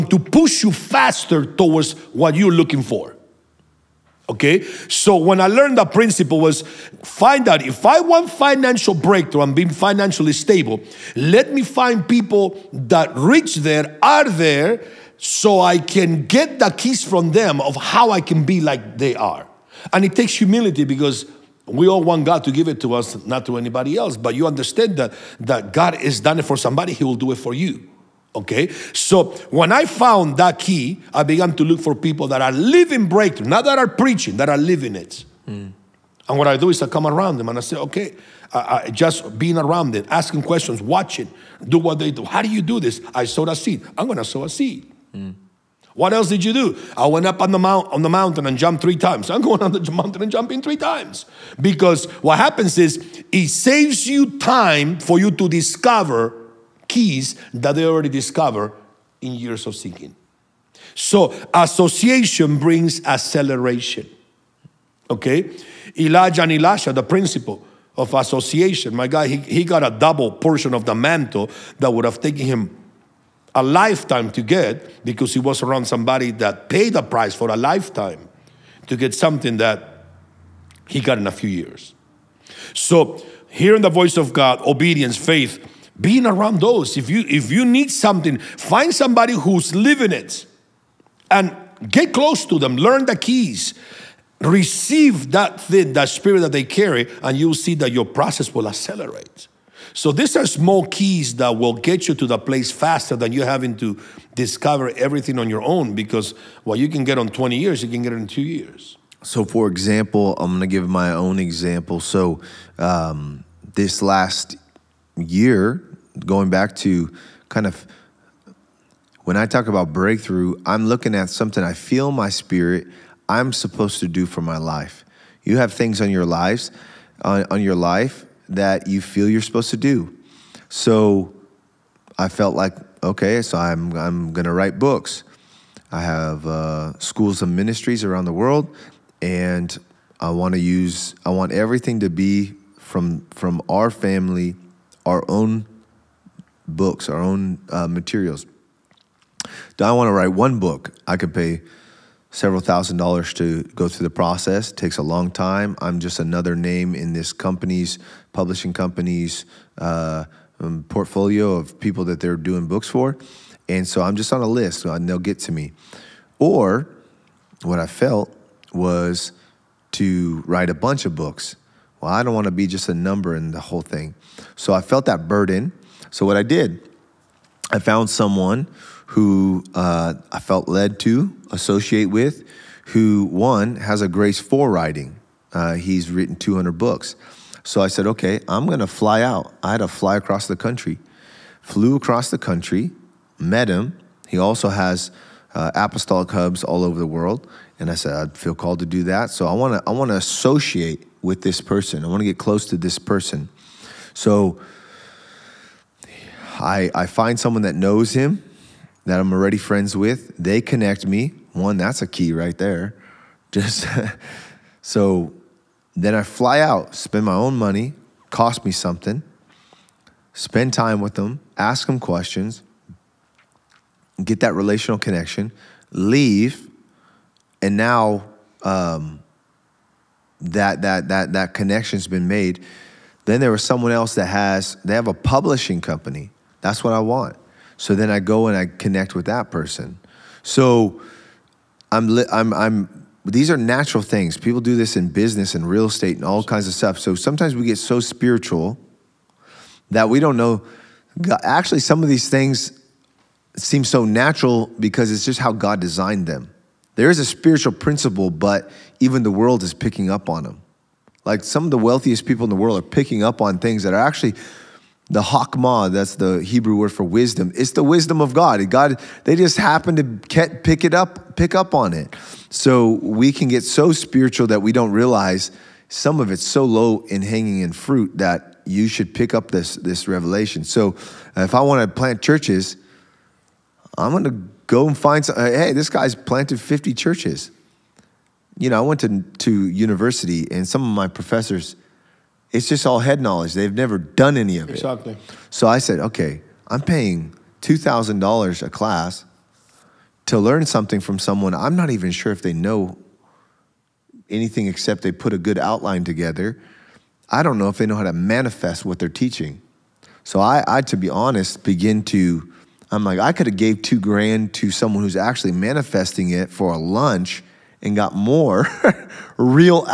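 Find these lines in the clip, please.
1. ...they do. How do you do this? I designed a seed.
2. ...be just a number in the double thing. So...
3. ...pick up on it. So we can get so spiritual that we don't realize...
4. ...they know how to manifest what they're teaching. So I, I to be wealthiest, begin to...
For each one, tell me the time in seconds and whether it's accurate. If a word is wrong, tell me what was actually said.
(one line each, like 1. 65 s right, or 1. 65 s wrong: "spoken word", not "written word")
1. 41 s wrong: "sowed", not "designed"
2. 172 s wrong: "whole", not "double"
3. 271 s right
4. 307 s wrong: "honest", not "wealthiest".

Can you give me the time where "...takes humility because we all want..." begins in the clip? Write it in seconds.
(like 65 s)
20 s.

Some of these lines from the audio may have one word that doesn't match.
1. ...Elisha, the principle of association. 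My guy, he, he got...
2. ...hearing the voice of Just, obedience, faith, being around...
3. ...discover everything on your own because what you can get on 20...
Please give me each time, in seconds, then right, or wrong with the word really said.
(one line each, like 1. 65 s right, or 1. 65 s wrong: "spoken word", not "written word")
1. 66 s right
2. 83 s wrong: "God", not "Just"
3. 104 s right.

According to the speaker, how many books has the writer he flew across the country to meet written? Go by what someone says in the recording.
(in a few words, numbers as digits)
200.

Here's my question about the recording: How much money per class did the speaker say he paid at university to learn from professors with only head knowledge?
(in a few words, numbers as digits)
$2,000.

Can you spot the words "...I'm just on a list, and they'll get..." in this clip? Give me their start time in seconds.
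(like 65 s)
164 s.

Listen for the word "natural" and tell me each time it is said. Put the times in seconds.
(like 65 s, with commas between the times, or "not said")
243 s, 254 s.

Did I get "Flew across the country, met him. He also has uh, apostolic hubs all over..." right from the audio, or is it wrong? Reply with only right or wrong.
right.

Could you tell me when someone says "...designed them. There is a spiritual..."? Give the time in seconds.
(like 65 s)
255 s.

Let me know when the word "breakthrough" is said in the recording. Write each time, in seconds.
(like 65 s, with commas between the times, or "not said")
8 s, 33 s, 119 s.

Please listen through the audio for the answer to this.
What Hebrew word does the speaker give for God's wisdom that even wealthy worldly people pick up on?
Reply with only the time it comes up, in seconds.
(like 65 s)
265 s.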